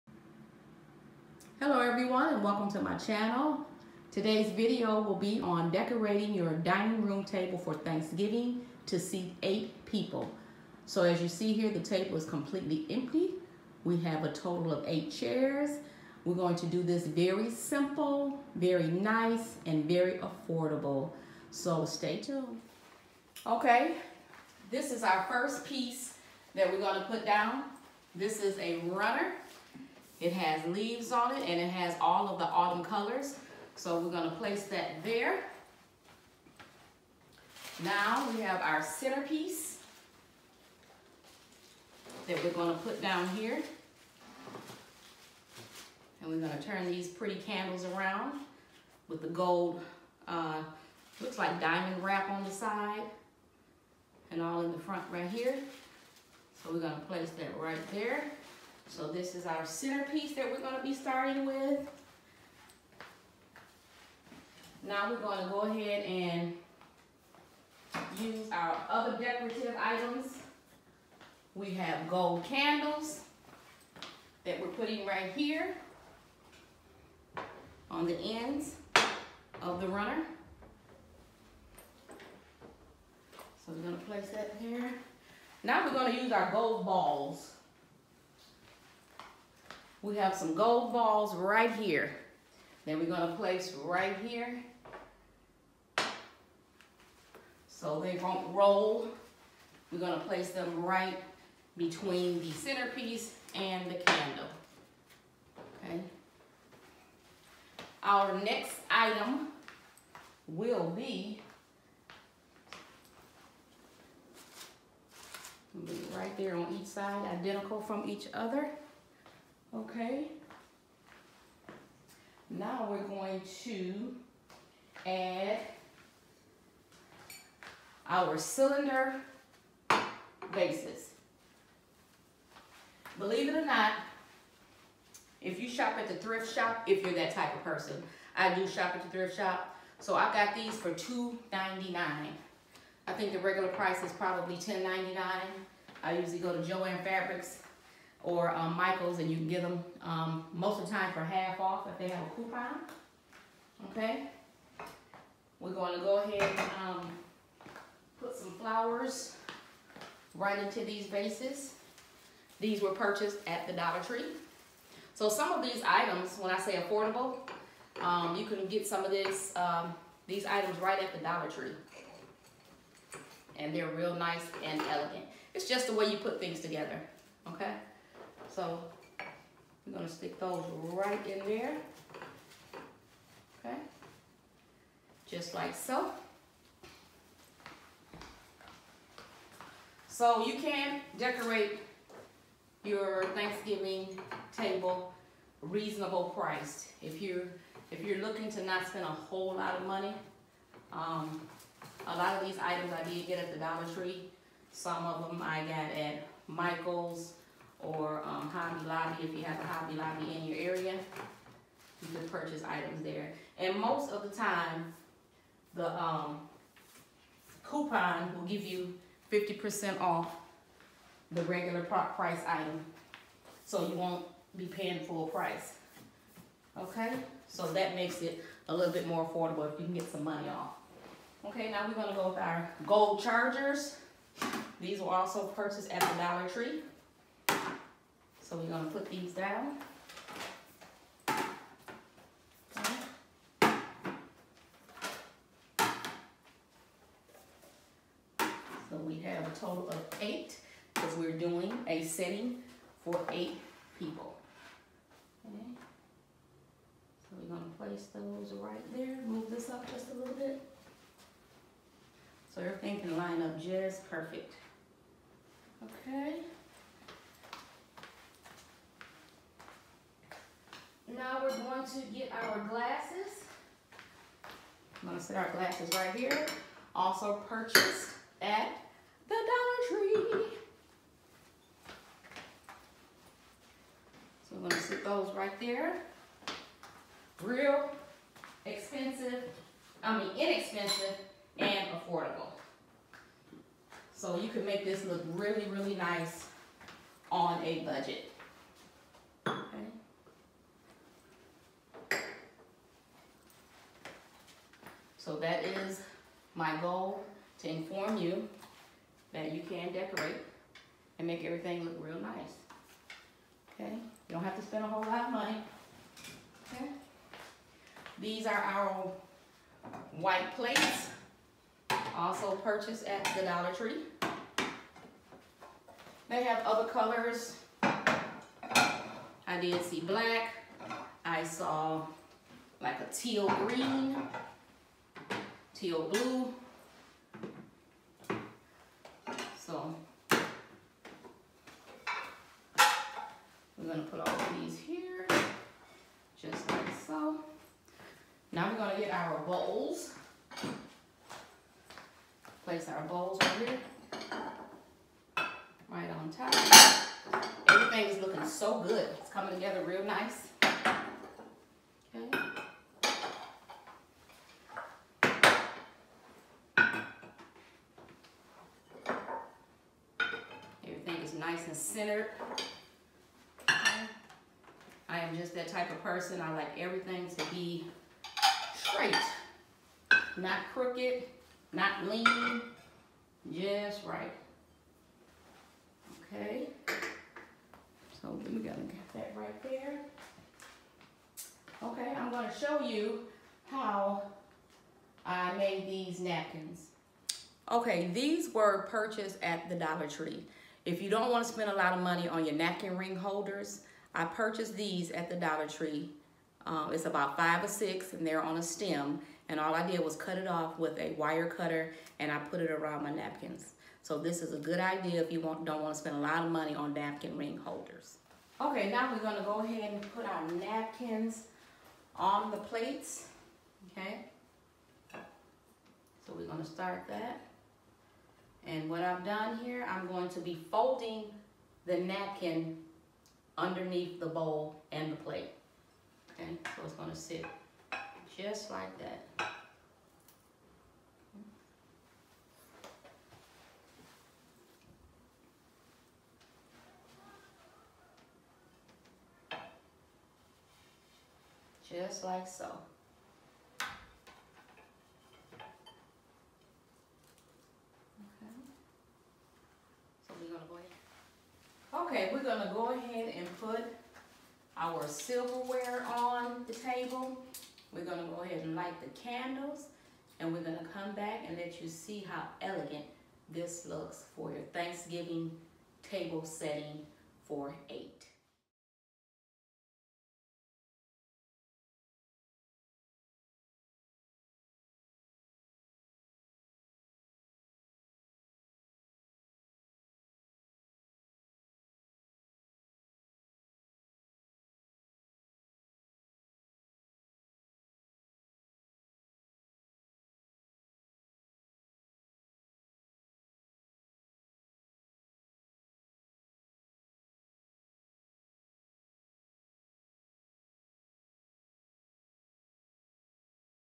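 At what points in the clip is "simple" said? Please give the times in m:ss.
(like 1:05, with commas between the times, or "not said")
0:17.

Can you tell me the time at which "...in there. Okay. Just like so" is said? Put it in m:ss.
3:01.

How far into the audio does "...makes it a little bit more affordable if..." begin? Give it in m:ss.
3:47.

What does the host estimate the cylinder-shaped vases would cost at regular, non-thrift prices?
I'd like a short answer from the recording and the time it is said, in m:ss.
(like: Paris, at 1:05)
$10.99, at 2:24.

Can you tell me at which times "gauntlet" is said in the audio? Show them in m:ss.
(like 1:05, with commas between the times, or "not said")
not said.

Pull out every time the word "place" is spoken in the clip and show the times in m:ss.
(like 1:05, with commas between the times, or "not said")
0:34, 0:57, 1:24, 1:33, 1:40, 4:17, 5:52.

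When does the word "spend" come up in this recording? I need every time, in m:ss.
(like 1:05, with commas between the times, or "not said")
3:18, 5:14, 6:41, 6:55.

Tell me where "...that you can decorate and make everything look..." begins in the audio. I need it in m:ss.
5:09.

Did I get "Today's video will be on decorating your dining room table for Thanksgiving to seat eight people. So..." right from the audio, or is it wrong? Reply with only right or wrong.
right.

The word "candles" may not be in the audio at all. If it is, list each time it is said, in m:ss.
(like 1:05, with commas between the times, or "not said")
0:47, 1:12, 1:43, 7:49.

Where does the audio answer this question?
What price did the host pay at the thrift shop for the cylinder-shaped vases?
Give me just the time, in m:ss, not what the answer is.
2:20.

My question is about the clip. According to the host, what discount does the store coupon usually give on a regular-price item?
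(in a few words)
50% off.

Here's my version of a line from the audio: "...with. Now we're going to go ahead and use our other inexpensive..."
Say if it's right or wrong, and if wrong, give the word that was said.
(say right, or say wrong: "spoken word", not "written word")
wrong: "decorative", not "inexpensive".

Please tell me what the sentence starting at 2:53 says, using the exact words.
And they're real nice and elegant.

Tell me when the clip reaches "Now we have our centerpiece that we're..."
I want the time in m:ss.
0:37.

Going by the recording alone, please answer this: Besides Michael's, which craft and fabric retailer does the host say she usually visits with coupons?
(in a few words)
Joann Fabrics.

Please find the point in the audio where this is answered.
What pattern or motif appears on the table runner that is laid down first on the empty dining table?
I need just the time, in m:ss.
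0:30.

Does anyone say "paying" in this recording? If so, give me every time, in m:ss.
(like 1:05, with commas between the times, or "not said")
3:44.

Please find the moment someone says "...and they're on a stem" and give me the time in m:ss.
6:48.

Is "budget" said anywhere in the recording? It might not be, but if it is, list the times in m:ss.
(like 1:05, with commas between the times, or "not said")
4:57.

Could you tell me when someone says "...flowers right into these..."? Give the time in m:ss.
2:38.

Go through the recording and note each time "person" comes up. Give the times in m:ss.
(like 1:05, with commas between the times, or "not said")
2:17, 6:16.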